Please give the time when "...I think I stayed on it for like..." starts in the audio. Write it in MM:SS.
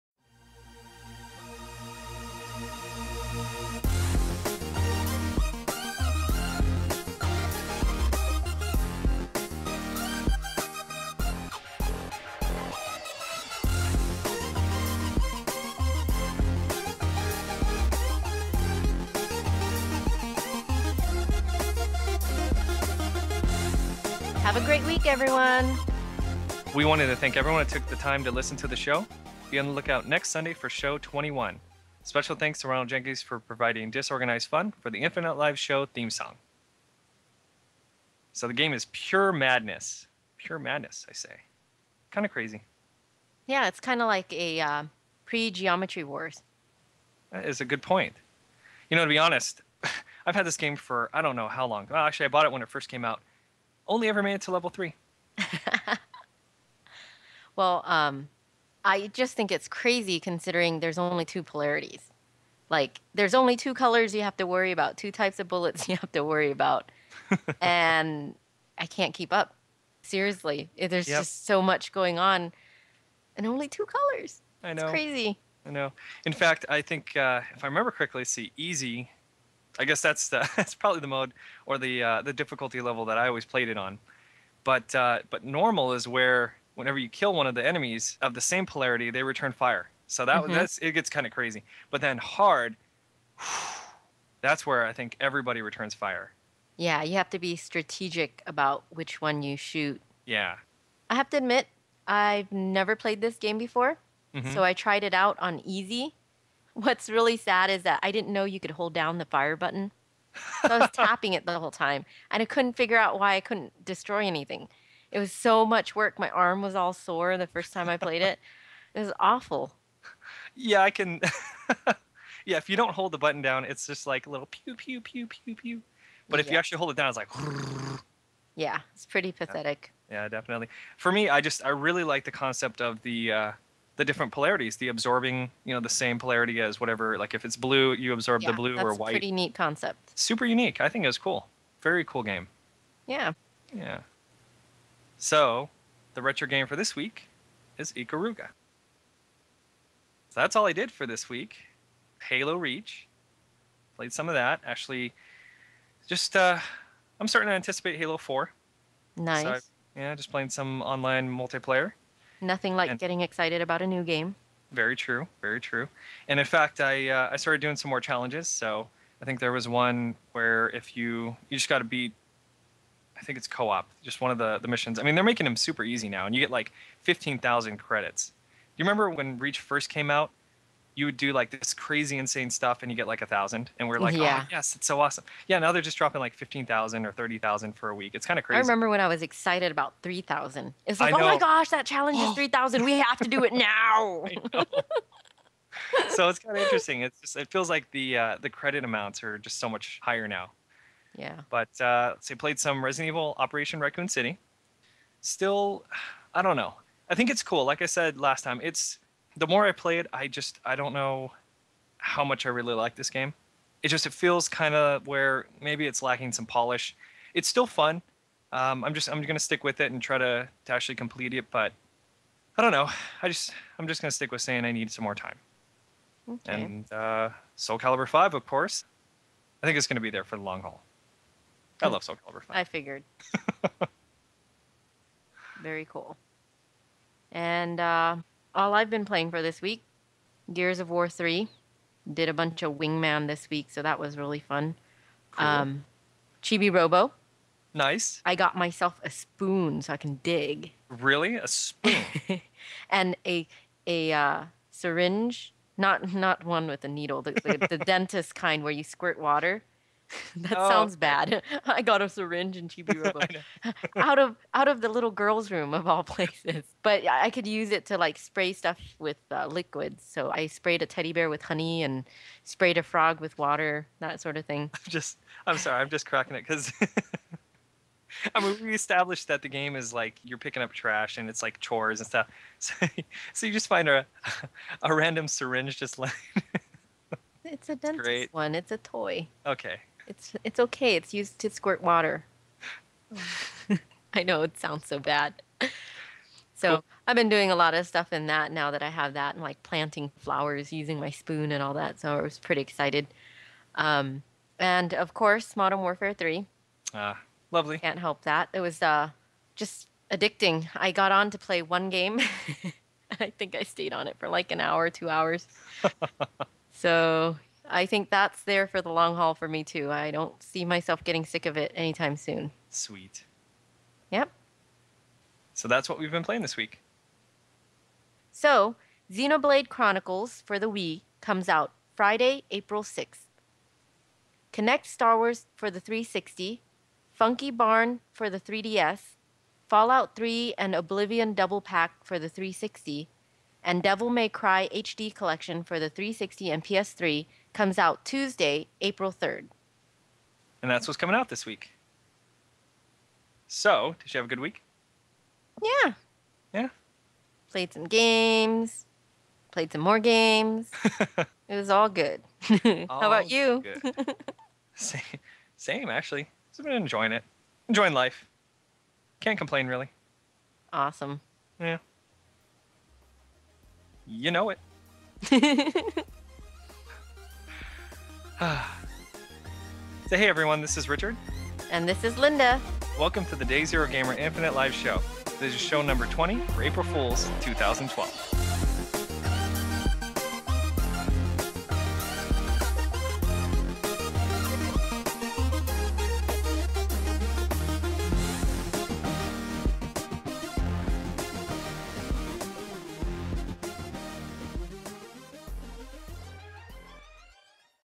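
05:13.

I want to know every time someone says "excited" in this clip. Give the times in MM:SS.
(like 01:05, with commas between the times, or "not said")
02:43, 03:09, 05:02.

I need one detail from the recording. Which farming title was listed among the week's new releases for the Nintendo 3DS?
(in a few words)
Funky Barn.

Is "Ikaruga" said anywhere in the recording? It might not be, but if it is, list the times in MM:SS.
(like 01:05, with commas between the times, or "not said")
02:27.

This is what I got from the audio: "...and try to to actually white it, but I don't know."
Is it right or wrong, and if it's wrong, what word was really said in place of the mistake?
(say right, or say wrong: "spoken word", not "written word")
wrong: "complete", not "white".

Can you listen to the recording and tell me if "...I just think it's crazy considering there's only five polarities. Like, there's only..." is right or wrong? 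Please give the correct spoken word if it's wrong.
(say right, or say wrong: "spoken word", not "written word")
wrong: "two", not "five".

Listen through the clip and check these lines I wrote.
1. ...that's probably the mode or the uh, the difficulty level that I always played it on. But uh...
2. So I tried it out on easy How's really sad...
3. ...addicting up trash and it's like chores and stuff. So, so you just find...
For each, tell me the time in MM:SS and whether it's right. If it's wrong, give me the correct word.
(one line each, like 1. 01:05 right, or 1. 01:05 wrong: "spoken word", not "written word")
1. 01:20 right
2. 01:44 wrong: "What", not "How"
3. 04:40 wrong: "picking", not "addicting".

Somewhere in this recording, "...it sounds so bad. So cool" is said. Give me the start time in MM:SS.
04:54.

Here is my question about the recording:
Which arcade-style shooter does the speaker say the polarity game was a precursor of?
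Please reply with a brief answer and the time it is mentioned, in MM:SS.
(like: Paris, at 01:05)
Geometry Wars, at 00:45.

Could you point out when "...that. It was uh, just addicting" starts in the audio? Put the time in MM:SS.
05:08.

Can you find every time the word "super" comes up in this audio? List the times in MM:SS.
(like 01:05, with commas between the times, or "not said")
02:20, 02:55.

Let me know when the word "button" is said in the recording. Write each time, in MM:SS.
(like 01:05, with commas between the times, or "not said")
01:49, 02:03.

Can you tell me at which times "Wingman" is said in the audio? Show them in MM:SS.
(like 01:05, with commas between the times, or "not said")
04:02.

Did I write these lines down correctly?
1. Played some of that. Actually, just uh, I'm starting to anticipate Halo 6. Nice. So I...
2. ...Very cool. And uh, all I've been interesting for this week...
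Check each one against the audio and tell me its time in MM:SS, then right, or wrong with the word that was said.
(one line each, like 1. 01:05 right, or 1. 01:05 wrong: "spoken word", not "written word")
1. 02:33 wrong: "4", not "6"
2. 03:55 wrong: "playing", not "interesting".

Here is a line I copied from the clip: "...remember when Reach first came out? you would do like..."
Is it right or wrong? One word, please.
right.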